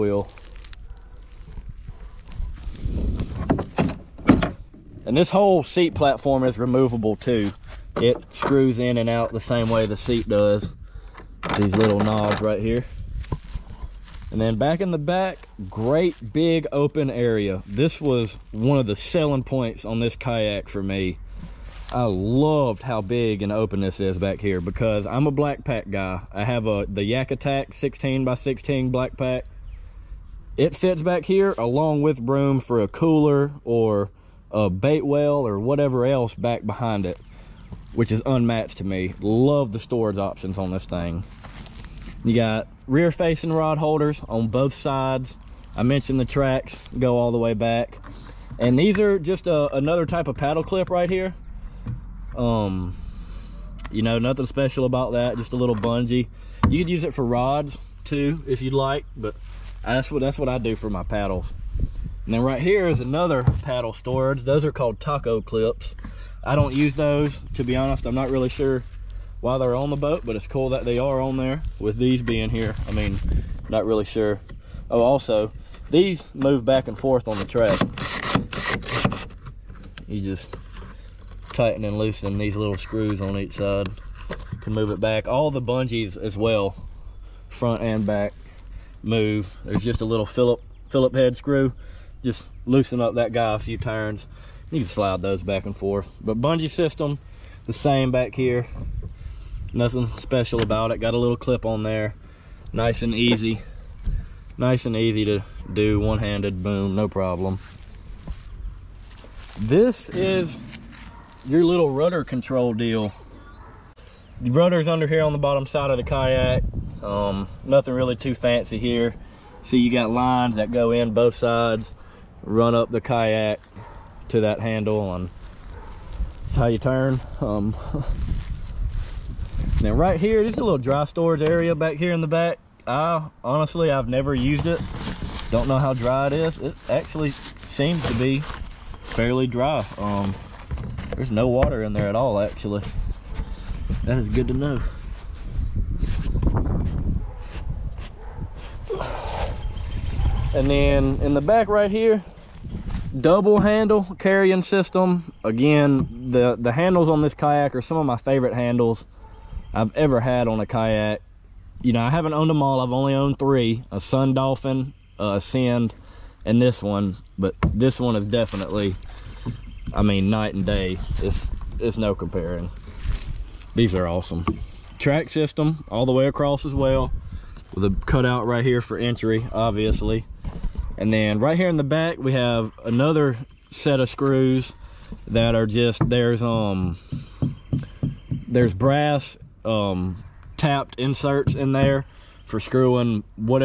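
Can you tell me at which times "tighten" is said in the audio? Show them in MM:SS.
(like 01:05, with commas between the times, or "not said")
01:21.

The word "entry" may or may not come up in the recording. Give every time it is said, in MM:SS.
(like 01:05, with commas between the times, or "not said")
02:58.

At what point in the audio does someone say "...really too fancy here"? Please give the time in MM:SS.
01:57.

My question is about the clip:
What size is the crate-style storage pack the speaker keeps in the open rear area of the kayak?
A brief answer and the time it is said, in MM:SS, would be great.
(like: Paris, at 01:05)
16 by 16, at 00:27.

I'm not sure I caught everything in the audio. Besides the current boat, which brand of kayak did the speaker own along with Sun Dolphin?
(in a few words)
Ascend.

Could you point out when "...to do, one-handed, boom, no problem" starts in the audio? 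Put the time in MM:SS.
01:45.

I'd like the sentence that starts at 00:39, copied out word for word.
Love the storage options on this thing.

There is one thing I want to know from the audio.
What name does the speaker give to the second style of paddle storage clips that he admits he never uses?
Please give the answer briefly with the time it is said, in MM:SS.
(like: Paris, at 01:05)
Taco clips, at 01:05.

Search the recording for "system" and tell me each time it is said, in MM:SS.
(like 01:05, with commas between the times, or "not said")
01:36, 02:34, 02:55.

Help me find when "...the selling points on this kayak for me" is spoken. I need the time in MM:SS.
00:18.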